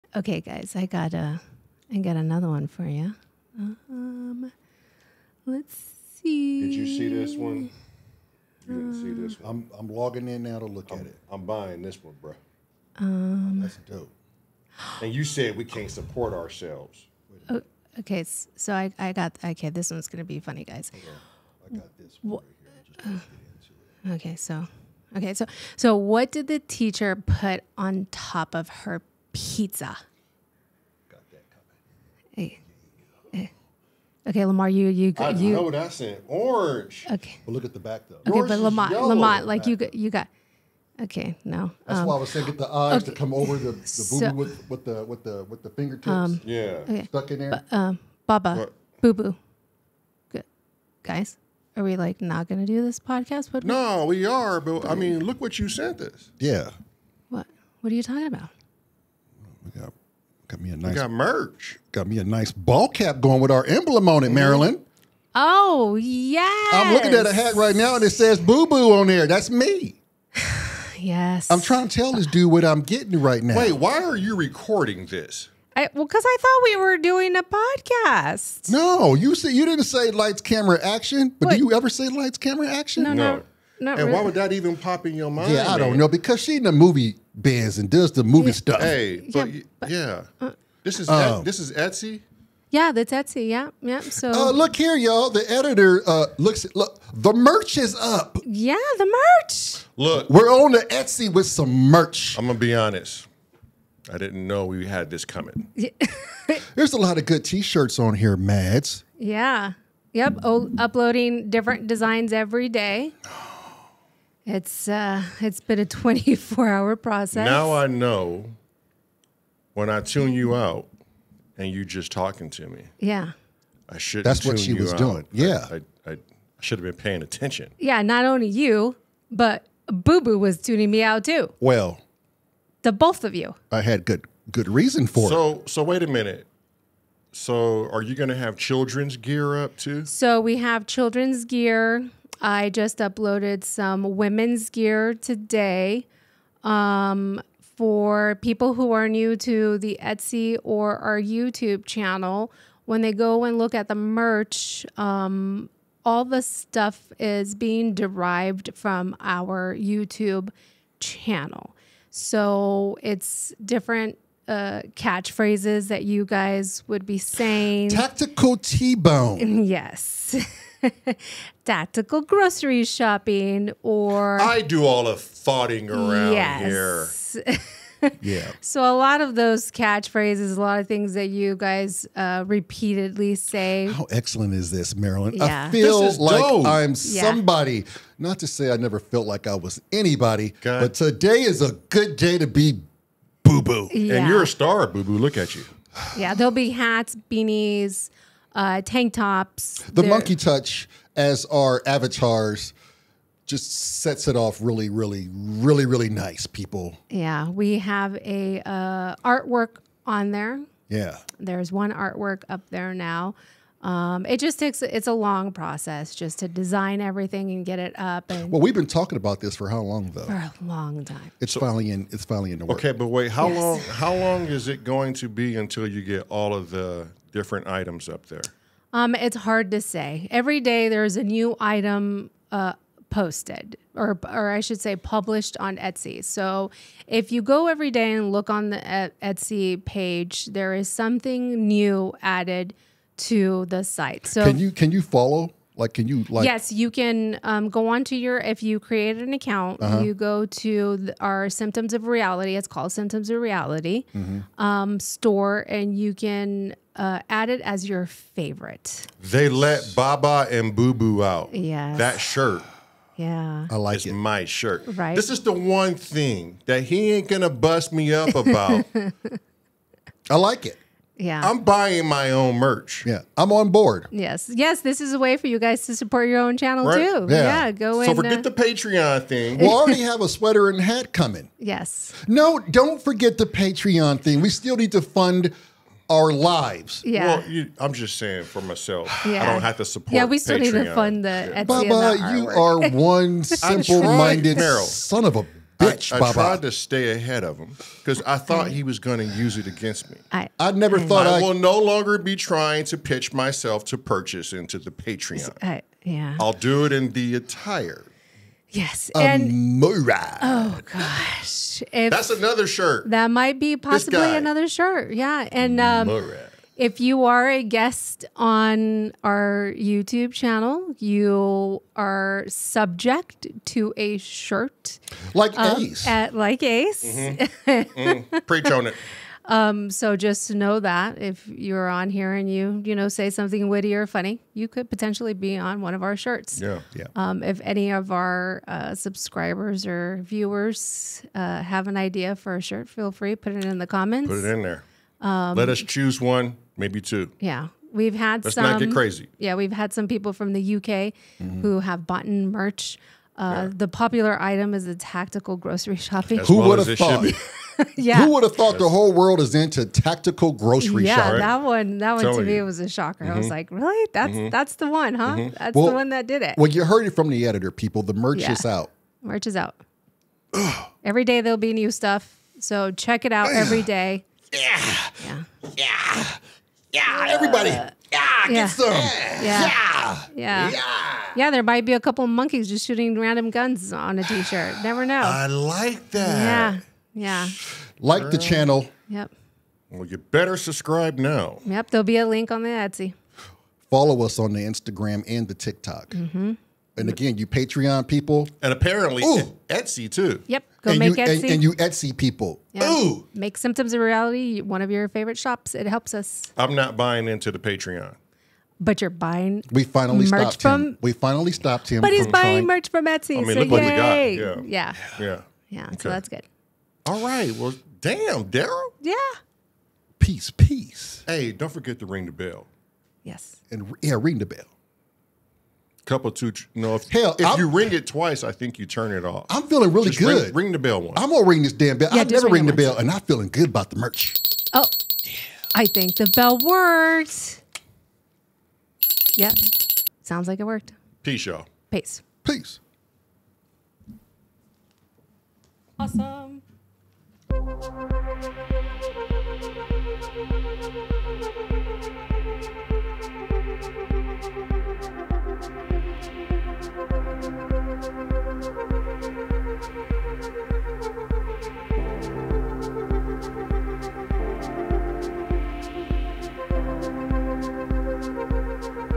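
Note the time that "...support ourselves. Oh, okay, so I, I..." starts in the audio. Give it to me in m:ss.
0:15.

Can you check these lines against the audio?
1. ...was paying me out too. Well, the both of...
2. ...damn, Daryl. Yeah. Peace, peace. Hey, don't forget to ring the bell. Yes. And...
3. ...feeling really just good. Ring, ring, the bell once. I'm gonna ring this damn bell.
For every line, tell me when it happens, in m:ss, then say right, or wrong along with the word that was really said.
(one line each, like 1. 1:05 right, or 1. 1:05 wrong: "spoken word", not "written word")
1. 2:10 wrong: "tuning", not "paying"
2. 6:58 right
3. 7:09 right.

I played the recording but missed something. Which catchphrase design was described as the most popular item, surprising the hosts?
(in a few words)
tactical grocery shopping.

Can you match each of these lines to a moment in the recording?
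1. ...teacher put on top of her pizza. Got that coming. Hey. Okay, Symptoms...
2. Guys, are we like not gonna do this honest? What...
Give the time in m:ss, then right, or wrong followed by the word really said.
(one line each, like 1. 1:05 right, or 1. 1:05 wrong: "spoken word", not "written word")
1. 0:26 wrong: "Lamar", not "Symptoms"
2. 0:51 wrong: "podcast", not "honest".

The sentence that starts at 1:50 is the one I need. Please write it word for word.
O uploading different designs every day.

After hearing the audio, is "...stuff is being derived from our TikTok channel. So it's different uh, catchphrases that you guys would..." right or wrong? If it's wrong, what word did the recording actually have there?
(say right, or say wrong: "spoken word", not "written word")
wrong: "YouTube", not "TikTok".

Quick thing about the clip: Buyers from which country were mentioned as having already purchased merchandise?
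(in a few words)
the UK.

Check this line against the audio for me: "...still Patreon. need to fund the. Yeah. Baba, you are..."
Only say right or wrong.
right.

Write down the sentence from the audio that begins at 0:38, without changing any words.
Okay, but Lamont, Lamont, like you got, you got.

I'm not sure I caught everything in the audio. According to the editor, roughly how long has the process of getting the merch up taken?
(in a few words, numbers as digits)
24 hours.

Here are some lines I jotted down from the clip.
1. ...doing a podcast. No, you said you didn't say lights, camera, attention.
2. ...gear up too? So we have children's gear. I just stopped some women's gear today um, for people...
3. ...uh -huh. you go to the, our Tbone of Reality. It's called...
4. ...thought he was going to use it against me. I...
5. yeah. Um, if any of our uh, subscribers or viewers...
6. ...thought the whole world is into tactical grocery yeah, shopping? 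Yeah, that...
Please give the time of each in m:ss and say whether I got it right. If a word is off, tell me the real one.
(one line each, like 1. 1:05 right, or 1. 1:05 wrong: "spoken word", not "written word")
1. 1:16 wrong: "action", not "attention"
2. 2:19 wrong: "uploaded", not "stopped"
3. 4:09 wrong: "Symptoms", not "Tbone"
4. 4:58 right
5. 5:36 right
6. 5:58 right.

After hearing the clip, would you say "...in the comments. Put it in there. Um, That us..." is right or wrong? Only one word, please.
wrong.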